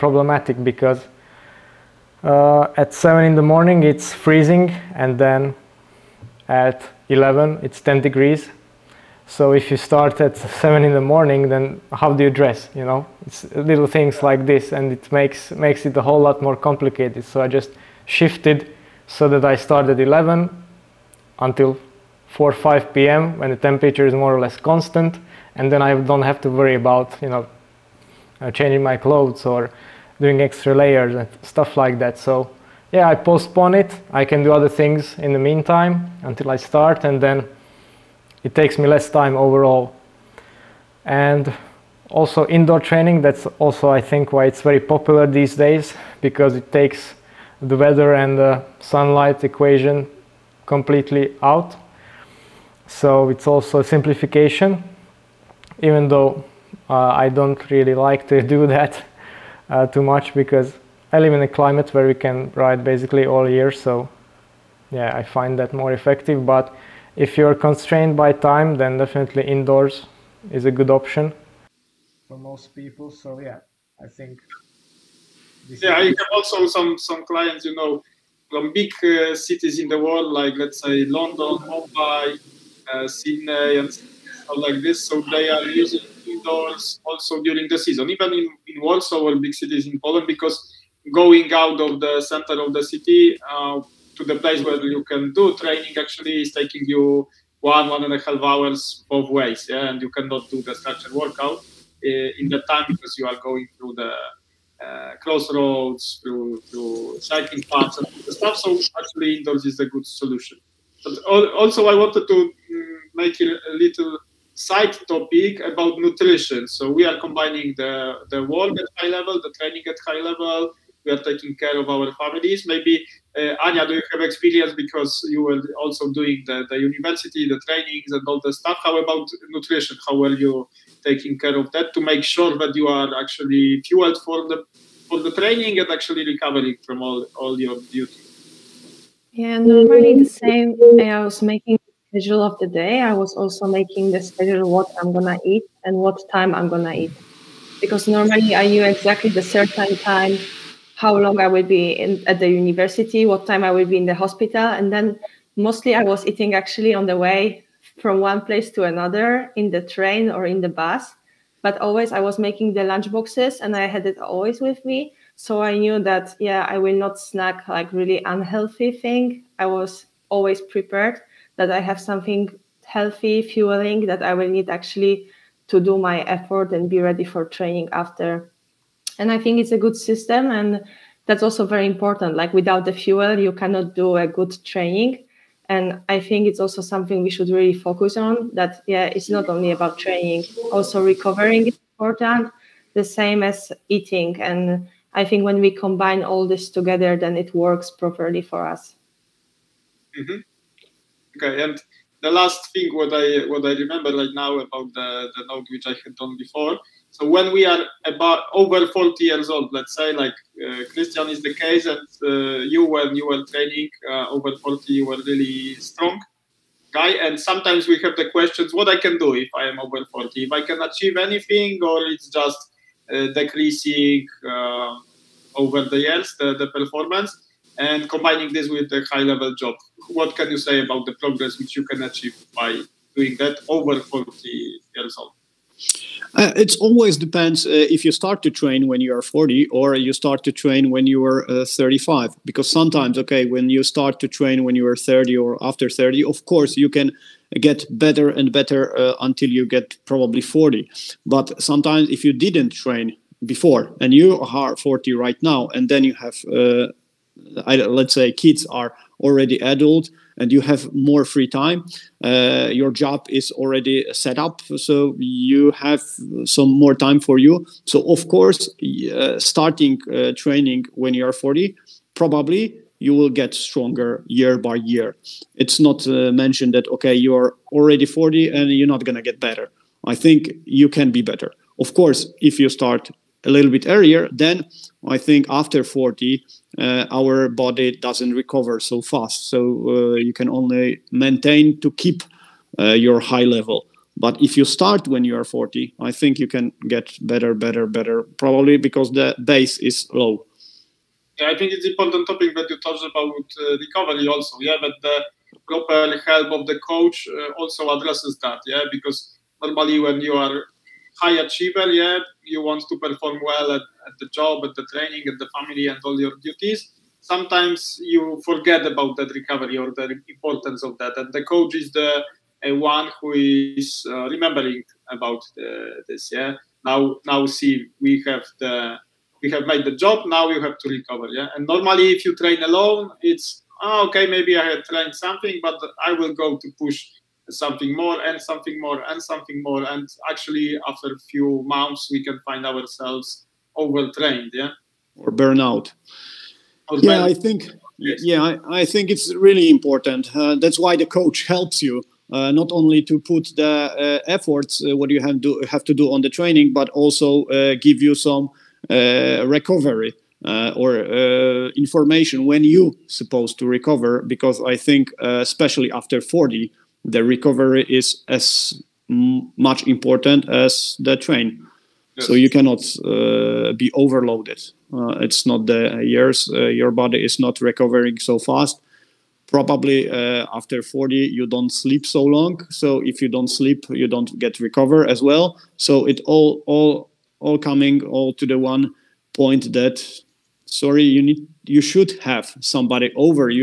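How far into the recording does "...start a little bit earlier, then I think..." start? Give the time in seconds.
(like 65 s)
282 s.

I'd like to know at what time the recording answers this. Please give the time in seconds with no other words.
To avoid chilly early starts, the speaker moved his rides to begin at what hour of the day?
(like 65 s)
19 s.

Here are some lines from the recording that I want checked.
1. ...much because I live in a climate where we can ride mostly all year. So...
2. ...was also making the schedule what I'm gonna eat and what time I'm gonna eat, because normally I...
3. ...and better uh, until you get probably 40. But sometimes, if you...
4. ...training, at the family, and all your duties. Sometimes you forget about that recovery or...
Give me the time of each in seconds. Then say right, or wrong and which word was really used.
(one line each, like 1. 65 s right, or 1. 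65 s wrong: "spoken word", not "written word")
1. 60 s wrong: "basically", not "mostly"
2. 143 s right
3. 248 s right
4. 314 s right.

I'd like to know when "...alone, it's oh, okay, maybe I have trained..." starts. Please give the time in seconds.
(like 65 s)
332 s.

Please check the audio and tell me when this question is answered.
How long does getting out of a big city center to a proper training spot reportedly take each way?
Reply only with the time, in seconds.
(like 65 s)
97 s.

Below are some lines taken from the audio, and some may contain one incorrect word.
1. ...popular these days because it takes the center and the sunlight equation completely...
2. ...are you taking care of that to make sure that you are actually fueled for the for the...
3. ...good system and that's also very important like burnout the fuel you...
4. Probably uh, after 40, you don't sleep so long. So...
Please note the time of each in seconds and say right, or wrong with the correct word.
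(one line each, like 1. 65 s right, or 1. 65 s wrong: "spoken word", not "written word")
1. 44 s wrong: "weather", not "center"
2. 130 s right
3. 179 s wrong: "without", not "burnout"
4. 379 s right.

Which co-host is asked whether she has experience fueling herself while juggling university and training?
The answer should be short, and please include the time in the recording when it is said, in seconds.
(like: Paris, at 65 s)
Anya, at 123 s.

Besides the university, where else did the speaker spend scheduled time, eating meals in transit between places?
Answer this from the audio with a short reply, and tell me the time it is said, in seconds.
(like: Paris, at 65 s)
The hospital, at 154 s.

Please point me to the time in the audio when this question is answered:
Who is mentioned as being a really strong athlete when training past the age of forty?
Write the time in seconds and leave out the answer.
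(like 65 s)
210 s.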